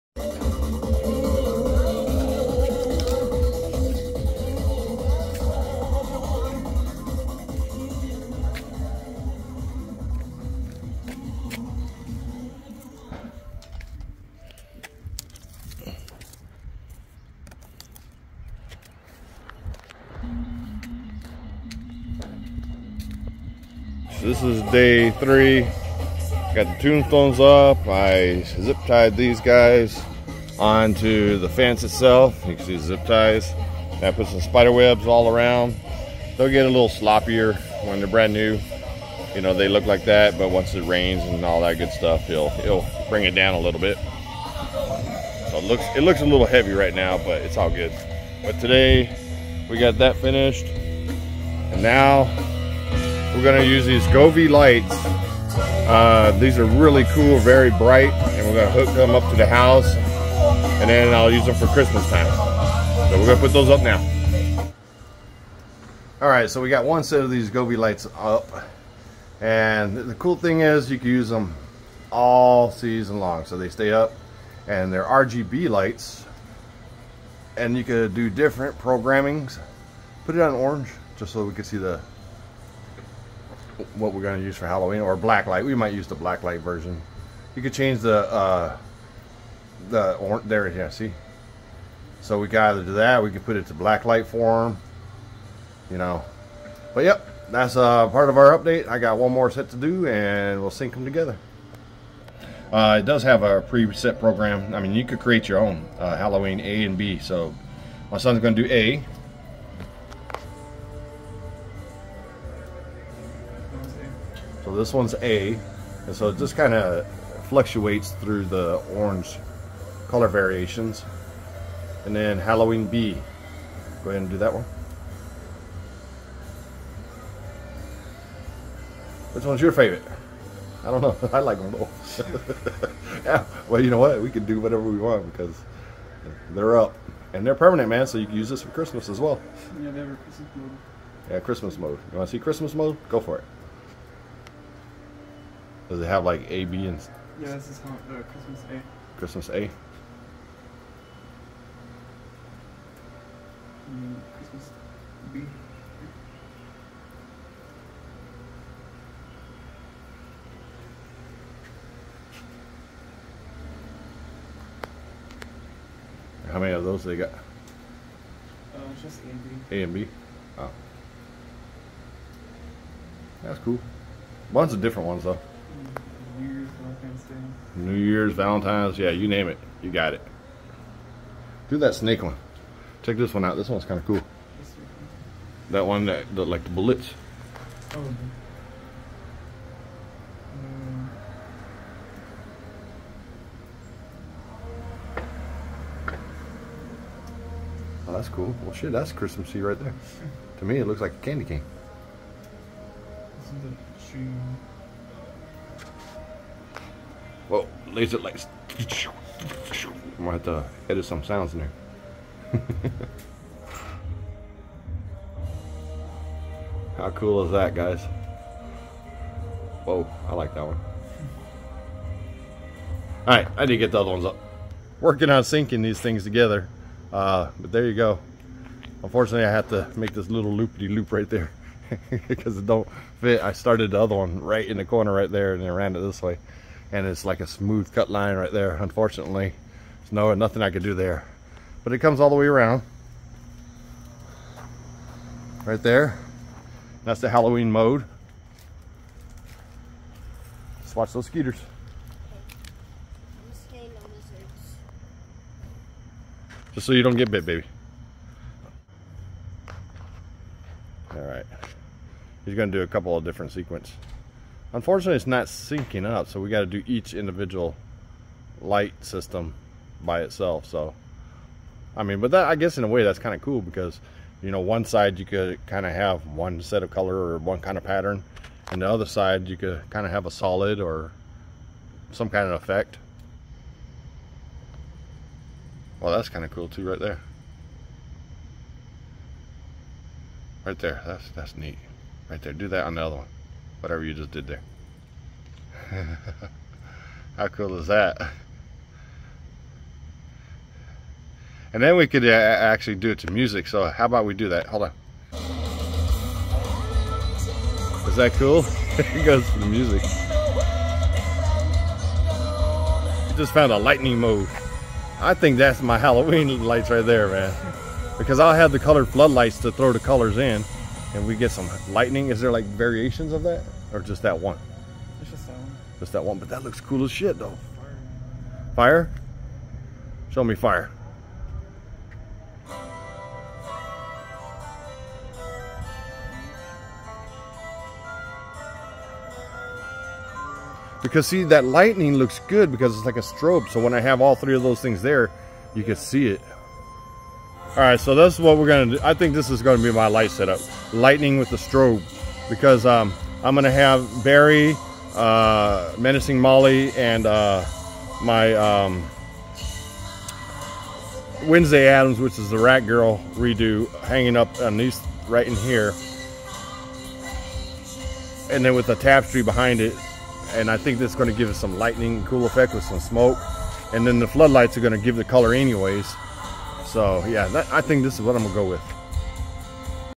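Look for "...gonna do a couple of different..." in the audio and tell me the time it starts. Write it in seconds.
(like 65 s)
262 s.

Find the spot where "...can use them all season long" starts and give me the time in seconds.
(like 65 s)
70 s.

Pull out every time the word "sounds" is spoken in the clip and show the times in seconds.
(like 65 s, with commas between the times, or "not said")
211 s.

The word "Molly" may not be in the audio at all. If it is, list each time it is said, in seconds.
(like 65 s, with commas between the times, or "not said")
356 s.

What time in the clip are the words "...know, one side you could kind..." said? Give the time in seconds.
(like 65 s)
274 s.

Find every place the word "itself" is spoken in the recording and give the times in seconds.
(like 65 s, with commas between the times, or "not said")
31 s, 270 s.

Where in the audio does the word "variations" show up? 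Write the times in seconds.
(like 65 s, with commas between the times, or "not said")
120 s, 322 s.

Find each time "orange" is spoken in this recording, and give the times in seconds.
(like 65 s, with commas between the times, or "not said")
80 s, 118 s.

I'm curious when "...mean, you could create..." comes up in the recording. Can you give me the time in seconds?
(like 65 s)
104 s.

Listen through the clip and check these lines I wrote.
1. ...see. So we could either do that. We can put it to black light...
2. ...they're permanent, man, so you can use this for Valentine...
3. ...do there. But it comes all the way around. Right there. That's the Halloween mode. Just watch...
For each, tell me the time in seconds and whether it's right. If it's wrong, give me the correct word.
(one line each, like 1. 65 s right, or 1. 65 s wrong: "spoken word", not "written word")
1. 90 s right
2. 137 s wrong: "Christmas", not "Valentine"
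3. 240 s right.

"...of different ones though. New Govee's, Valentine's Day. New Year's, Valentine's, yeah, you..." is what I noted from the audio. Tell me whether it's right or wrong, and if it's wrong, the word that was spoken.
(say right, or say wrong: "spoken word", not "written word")
wrong: "Year", not "Govee".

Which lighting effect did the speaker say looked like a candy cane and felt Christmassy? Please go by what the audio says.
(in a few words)
Bullets.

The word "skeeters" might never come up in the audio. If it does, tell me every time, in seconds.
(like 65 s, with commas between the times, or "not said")
251 s.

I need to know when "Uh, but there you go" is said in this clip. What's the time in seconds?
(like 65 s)
227 s.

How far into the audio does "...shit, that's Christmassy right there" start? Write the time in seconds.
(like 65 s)
198 s.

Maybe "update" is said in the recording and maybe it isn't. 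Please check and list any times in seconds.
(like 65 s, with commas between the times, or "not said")
98 s.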